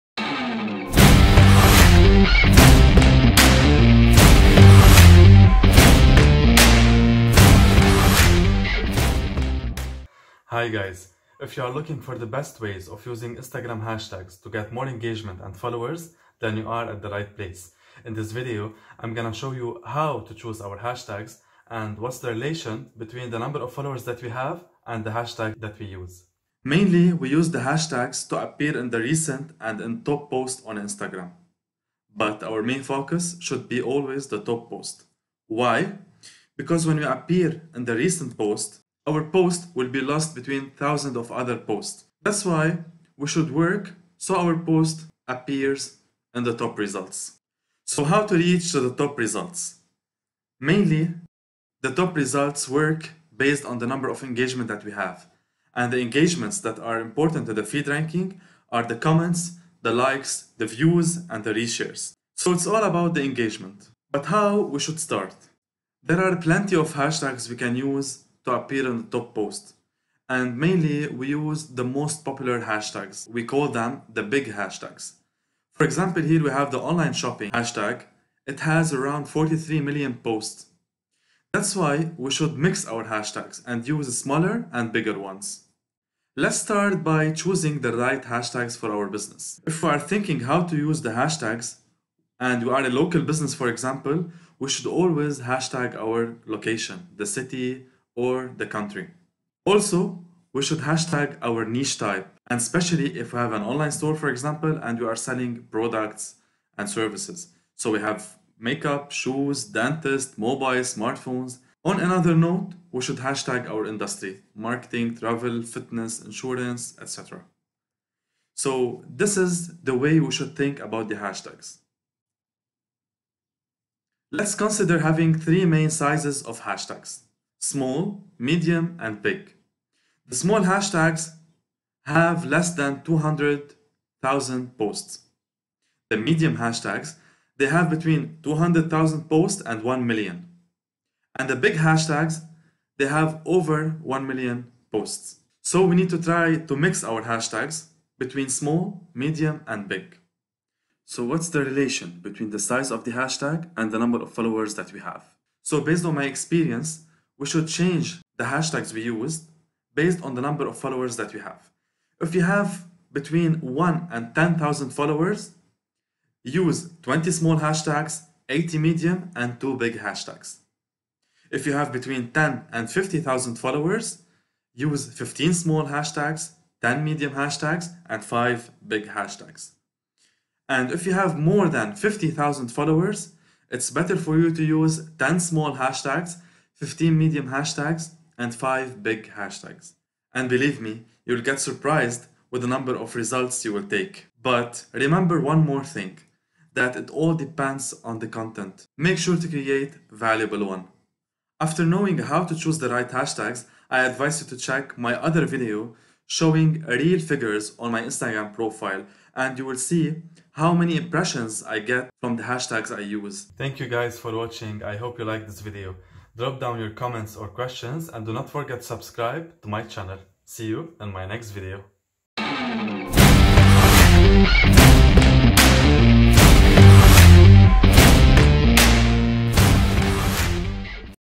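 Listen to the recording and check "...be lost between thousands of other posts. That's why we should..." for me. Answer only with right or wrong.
right.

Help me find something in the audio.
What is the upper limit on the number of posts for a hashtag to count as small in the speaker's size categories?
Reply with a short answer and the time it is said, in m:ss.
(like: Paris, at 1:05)
200,000, at 2:12.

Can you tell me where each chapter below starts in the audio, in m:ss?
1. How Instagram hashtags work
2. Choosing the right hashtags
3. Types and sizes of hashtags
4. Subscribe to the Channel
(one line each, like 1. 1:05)
1. 0:26
2. 1:26
3. 2:02
4. 3:34.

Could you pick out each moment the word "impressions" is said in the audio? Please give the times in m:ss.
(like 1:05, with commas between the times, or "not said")
3:30.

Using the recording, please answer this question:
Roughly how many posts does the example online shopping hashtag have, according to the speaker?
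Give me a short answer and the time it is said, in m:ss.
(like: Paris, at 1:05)
43 million, at 1:19.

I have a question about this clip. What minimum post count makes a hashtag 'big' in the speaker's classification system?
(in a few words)
1 million.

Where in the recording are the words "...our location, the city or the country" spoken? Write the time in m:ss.
1:35.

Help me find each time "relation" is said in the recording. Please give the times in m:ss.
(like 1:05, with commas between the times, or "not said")
0:22, 2:31.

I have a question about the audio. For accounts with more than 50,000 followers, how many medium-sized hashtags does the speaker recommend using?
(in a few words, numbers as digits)
15.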